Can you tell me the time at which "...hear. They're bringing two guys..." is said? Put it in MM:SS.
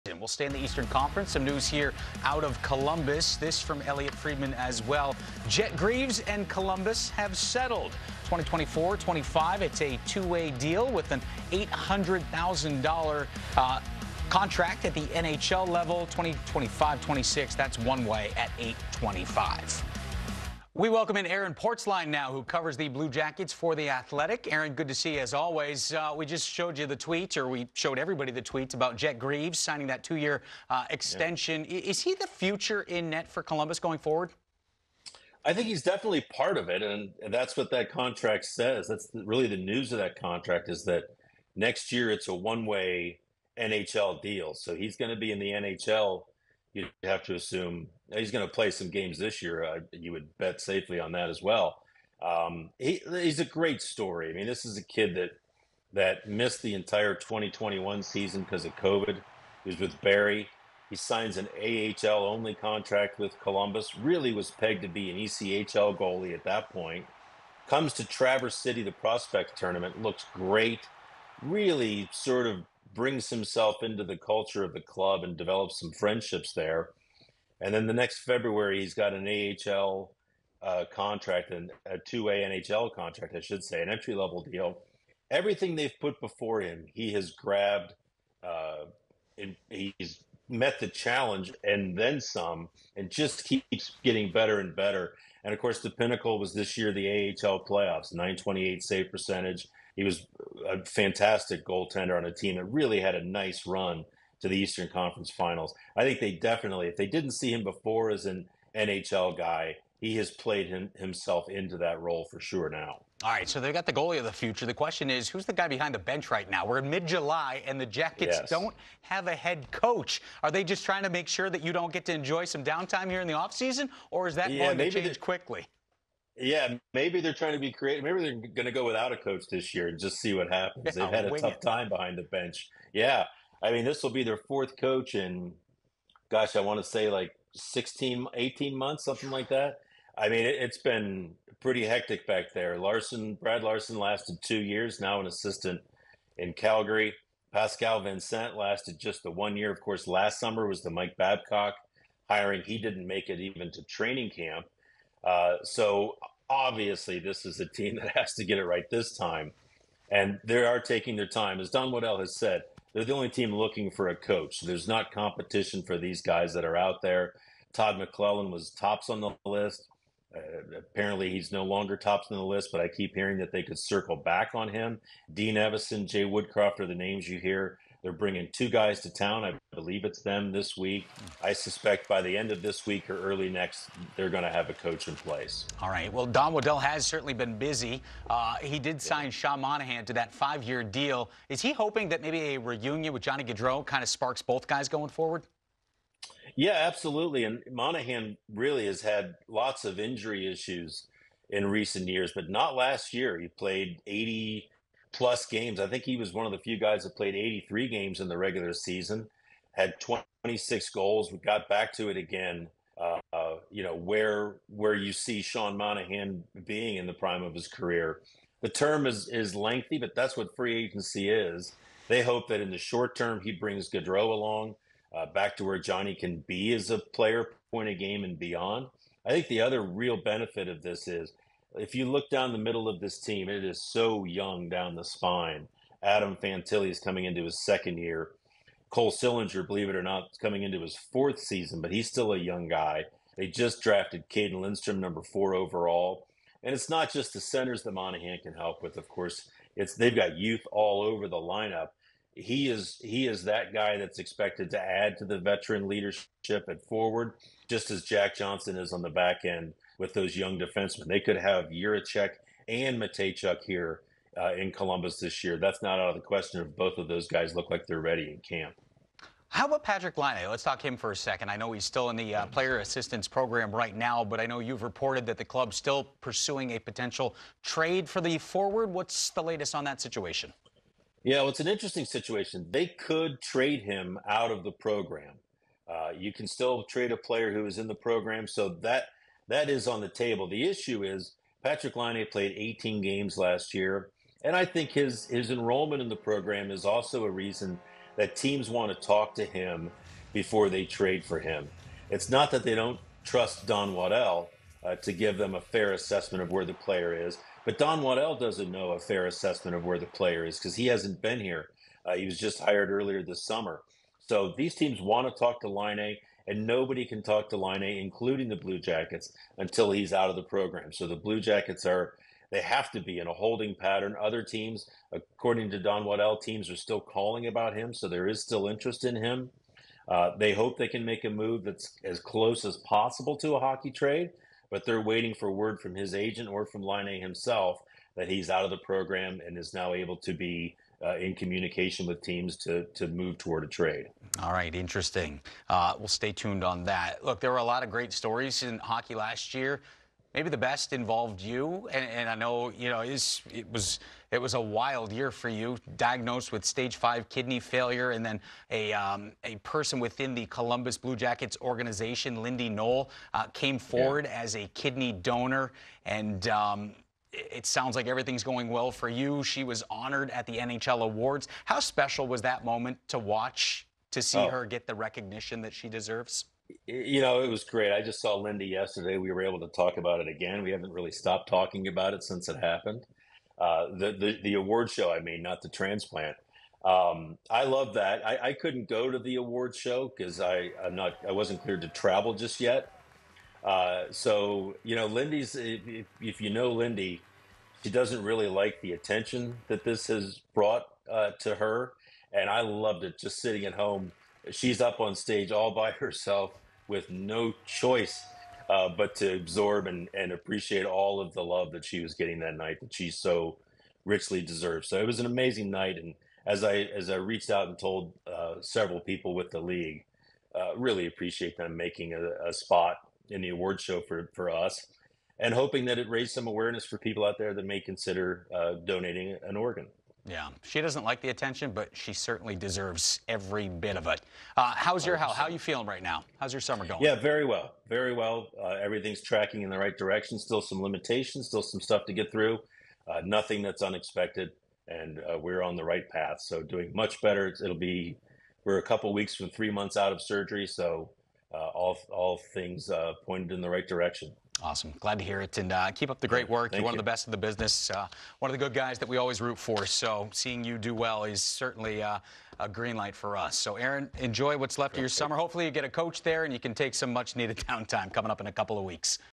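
02:57.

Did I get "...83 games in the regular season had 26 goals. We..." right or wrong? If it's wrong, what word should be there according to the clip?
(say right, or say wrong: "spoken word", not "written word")
right.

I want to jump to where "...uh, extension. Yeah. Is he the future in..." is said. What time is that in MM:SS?
00:30.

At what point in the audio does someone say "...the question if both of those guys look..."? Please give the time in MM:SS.
04:26.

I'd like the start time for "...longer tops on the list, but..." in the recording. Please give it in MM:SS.
02:51.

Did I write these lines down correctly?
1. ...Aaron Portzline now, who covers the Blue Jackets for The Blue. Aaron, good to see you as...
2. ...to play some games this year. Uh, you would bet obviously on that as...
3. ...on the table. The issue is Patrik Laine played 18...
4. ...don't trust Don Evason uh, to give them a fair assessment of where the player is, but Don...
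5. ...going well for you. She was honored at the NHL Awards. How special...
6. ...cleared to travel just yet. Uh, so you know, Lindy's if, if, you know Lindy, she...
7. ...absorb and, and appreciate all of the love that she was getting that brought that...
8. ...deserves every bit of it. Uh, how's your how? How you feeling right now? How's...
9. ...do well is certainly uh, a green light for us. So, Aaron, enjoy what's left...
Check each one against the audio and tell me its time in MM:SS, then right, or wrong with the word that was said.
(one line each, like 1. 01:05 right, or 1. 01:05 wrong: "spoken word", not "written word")
1. 00:21 wrong: "Athletic", not "Blue"
2. 00:48 wrong: "safely", not "obviously"
3. 04:49 right
4. 05:02 wrong: "Waddell", not "Evason"
5. 06:08 right
6. 06:31 right
7. 06:49 wrong: "night", not "brought"
8. 07:12 right
9. 07:40 right.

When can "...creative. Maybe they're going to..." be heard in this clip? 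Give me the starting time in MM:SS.
02:07.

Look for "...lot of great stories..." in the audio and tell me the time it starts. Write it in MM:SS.
05:47.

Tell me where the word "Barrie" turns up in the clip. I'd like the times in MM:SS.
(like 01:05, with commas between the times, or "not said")
00:59.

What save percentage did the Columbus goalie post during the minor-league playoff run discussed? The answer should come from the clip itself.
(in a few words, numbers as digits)
928.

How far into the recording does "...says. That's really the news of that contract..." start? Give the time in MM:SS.
00:38.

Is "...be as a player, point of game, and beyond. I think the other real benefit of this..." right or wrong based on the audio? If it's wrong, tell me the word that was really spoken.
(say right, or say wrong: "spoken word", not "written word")
right.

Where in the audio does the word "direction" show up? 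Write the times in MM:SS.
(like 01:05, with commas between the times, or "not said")
07:19, 07:33.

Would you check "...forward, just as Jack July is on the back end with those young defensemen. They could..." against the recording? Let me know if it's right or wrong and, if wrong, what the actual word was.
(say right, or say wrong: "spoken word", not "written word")
wrong: "Johnson", not "July".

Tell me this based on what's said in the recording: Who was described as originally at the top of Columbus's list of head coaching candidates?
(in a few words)
Todd McLellan.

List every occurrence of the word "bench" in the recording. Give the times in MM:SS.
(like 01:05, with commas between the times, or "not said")
01:55, 02:12.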